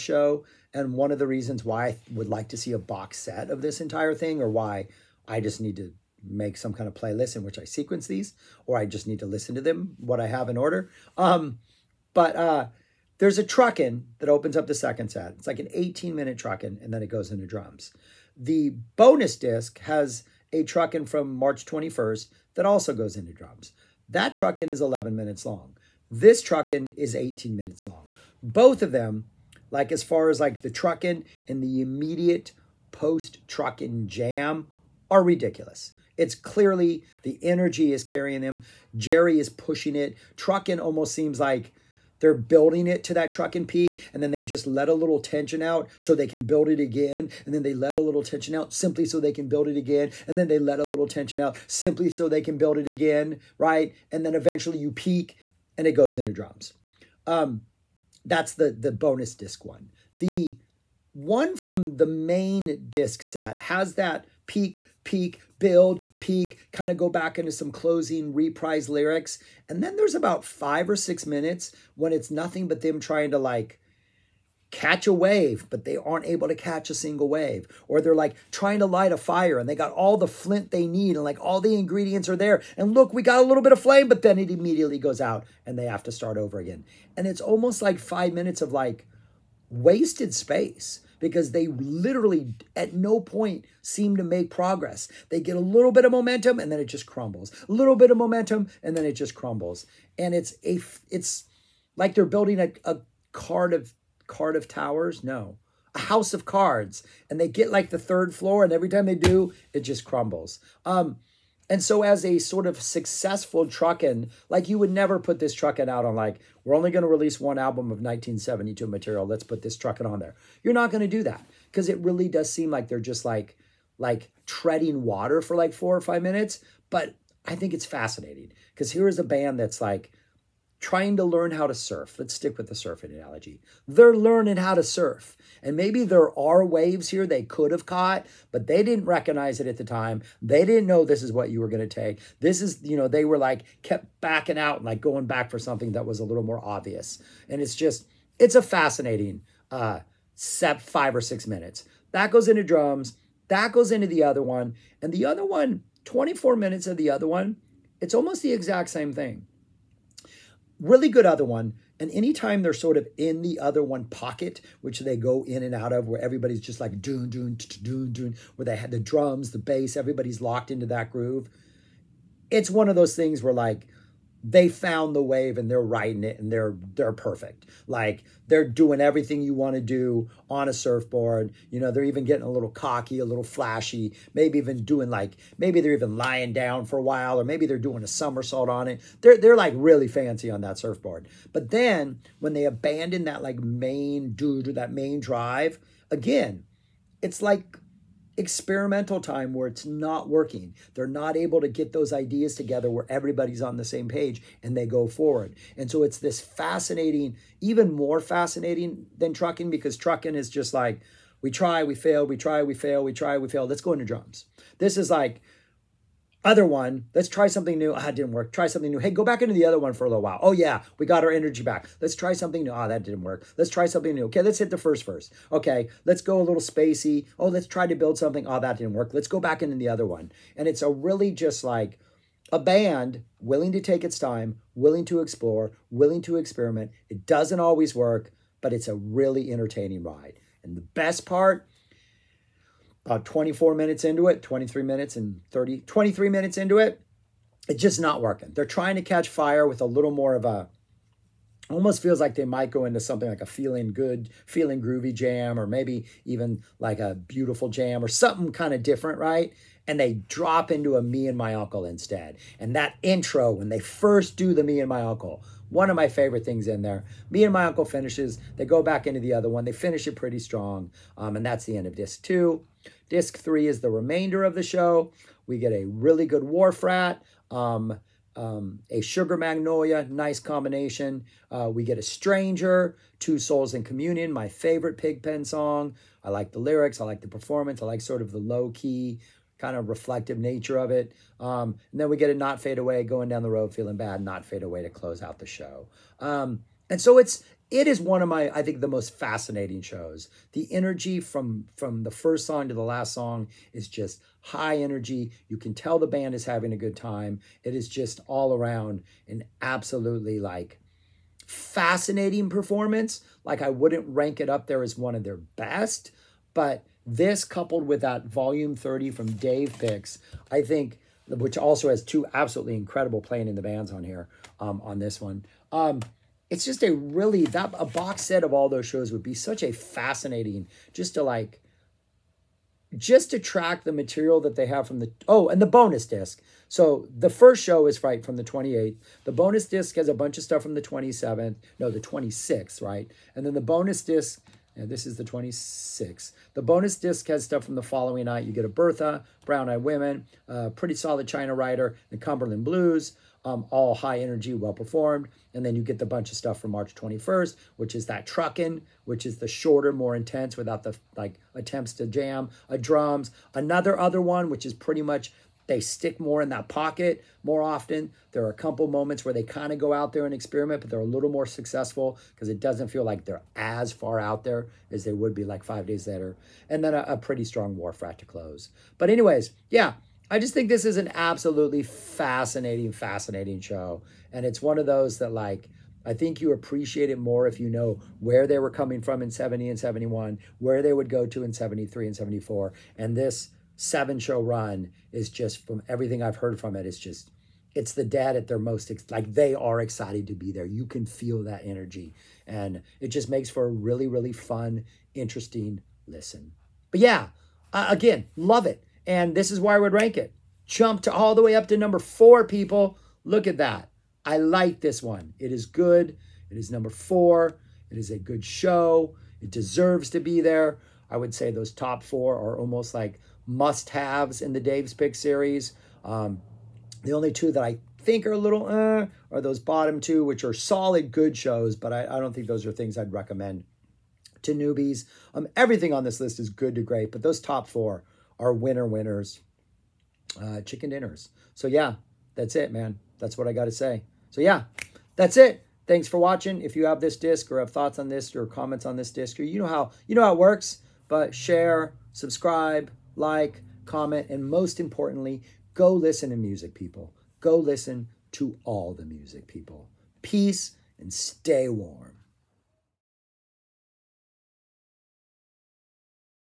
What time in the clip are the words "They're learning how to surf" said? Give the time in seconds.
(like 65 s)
133 s.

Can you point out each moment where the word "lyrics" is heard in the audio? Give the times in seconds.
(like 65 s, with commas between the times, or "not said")
68 s, 286 s.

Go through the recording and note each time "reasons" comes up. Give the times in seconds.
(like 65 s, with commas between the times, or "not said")
1 s.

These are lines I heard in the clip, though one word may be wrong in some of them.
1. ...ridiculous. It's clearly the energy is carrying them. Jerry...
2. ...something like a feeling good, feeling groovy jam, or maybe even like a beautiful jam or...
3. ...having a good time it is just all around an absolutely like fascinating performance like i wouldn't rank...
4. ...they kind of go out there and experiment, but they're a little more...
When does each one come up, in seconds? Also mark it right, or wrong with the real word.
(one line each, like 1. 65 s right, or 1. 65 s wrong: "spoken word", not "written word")
1. 35 s right
2. 253 s right
3. 306 s right
4. 369 s right.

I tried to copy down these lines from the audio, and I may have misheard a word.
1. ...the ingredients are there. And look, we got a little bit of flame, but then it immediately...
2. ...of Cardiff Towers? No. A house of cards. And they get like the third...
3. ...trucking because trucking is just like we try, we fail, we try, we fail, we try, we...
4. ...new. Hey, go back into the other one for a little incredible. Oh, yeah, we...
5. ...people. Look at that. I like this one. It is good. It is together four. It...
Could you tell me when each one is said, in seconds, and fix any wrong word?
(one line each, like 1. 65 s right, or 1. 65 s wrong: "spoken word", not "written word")
1. 81 s right
2. 103 s right
3. 209 s right
4. 218 s wrong: "while", not "incredible"
5. 412 s wrong: "number", not "together".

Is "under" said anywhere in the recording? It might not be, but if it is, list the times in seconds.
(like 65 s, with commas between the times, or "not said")
not said.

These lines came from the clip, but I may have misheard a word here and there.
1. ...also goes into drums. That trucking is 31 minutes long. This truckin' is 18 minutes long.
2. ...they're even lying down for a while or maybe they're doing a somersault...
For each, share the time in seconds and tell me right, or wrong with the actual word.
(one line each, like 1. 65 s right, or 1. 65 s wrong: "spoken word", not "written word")
1. 22 s wrong: "11", not "31"
2. 185 s right.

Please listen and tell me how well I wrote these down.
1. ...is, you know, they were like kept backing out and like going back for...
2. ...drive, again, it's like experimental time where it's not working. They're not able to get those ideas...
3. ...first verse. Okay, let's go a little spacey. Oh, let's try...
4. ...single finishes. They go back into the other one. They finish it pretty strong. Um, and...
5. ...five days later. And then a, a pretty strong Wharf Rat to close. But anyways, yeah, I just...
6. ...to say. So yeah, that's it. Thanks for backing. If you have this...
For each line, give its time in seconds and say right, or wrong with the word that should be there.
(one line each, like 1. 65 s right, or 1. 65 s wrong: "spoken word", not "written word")
1. 142 s right
2. 195 s right
3. 224 s right
4. 267 s wrong: "uncle", not "single"
5. 375 s right
6. 443 s wrong: "watching", not "backing".